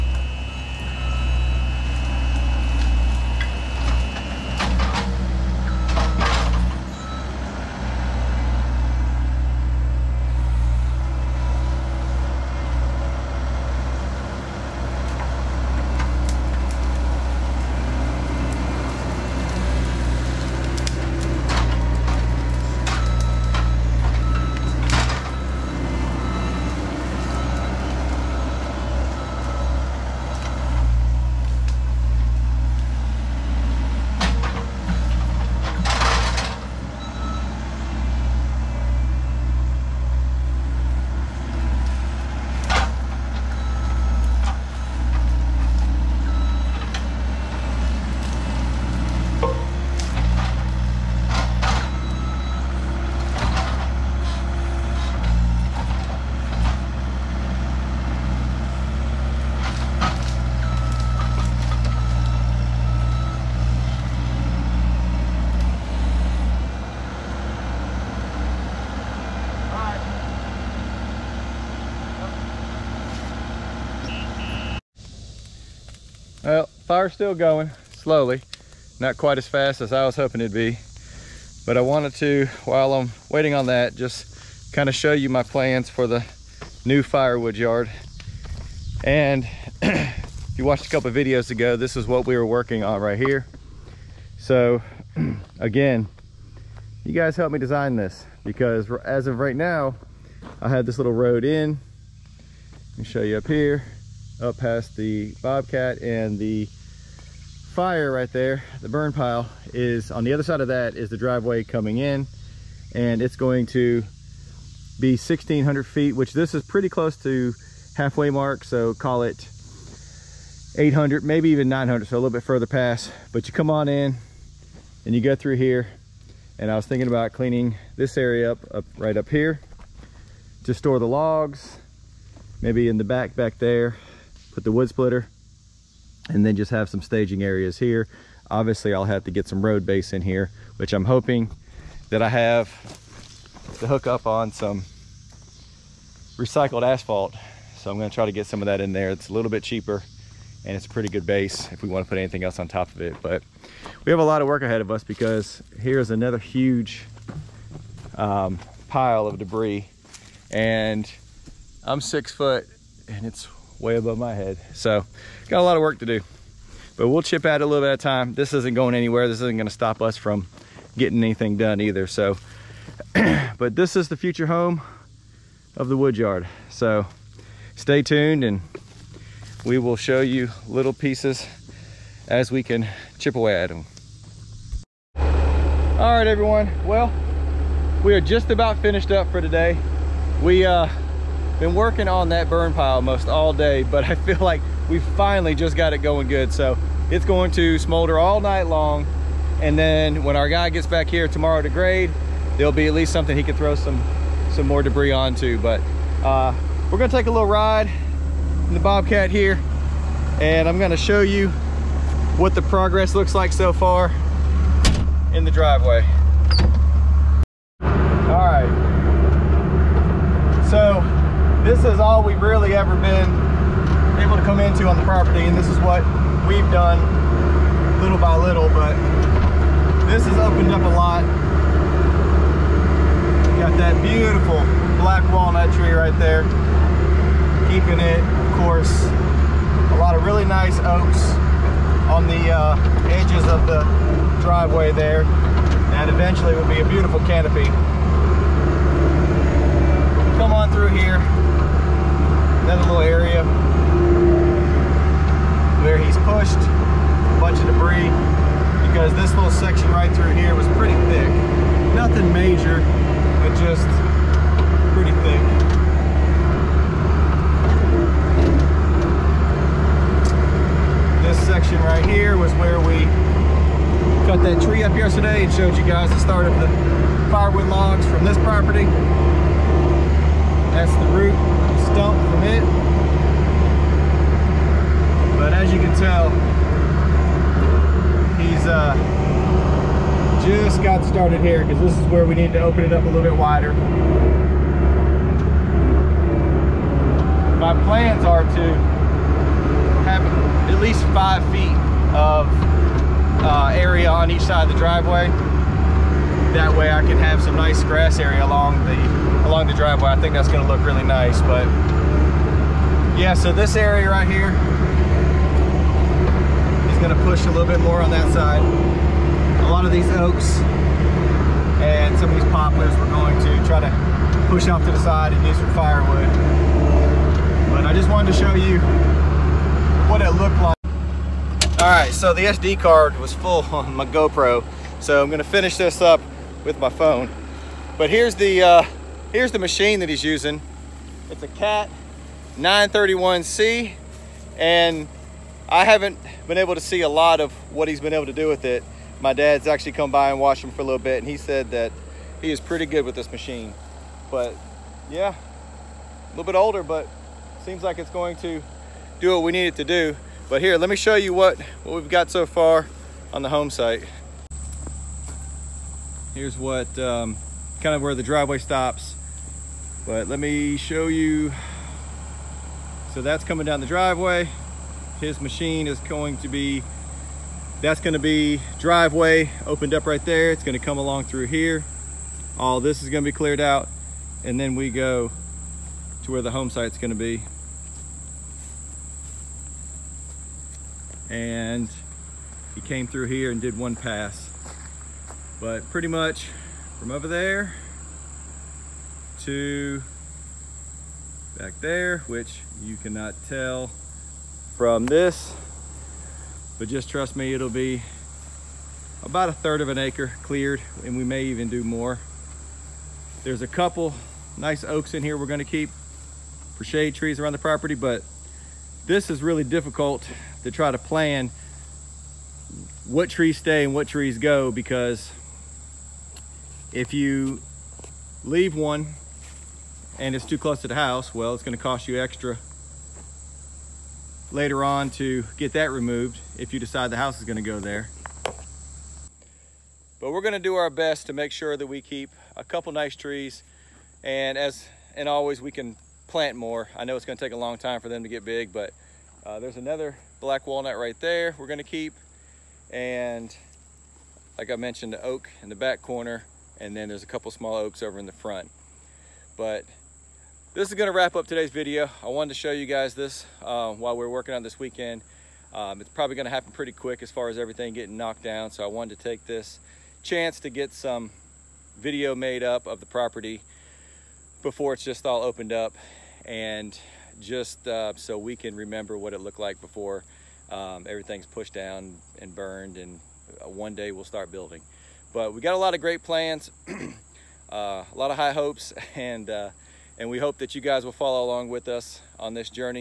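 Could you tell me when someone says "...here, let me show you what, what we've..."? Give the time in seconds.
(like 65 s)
360 s.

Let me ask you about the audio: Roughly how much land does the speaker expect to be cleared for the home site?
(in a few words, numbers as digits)
a third of an acre.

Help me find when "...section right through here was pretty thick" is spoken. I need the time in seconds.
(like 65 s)
259 s.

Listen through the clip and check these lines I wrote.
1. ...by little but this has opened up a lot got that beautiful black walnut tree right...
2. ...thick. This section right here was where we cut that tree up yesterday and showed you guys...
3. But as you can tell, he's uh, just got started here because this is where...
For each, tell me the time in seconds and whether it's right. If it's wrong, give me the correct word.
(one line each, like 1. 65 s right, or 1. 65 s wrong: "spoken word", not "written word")
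1. 228 s right
2. 265 s right
3. 285 s right.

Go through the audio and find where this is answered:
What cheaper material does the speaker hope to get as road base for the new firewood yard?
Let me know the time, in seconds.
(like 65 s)
146 s.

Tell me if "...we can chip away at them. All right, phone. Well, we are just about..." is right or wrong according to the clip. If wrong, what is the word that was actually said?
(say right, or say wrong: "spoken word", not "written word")
wrong: "everyone", not "phone".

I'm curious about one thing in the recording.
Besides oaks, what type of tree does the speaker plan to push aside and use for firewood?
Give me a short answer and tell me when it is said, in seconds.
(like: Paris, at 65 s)
poplars, at 322 s.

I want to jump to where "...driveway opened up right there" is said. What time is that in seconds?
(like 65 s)
378 s.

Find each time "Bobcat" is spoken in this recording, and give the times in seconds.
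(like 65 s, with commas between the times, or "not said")
105 s, 208 s.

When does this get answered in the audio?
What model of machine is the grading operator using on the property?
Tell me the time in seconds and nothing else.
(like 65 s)
341 s.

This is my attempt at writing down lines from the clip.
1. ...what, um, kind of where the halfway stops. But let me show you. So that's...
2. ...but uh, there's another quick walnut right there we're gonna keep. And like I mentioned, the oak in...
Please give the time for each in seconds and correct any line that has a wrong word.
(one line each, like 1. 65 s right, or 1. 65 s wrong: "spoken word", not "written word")
1. 366 s wrong: "driveway", not "halfway"
2. 448 s wrong: "black", not "quick".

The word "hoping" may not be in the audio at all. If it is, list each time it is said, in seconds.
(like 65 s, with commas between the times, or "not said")
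80 s, 141 s.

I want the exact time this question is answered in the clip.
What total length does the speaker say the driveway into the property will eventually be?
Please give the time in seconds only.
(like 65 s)
115 s.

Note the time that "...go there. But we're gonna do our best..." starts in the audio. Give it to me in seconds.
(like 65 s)
437 s.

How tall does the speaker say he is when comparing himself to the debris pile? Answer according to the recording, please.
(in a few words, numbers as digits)
six foot.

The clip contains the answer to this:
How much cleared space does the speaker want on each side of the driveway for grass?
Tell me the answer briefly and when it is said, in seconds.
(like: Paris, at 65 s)
five feet, at 301 s.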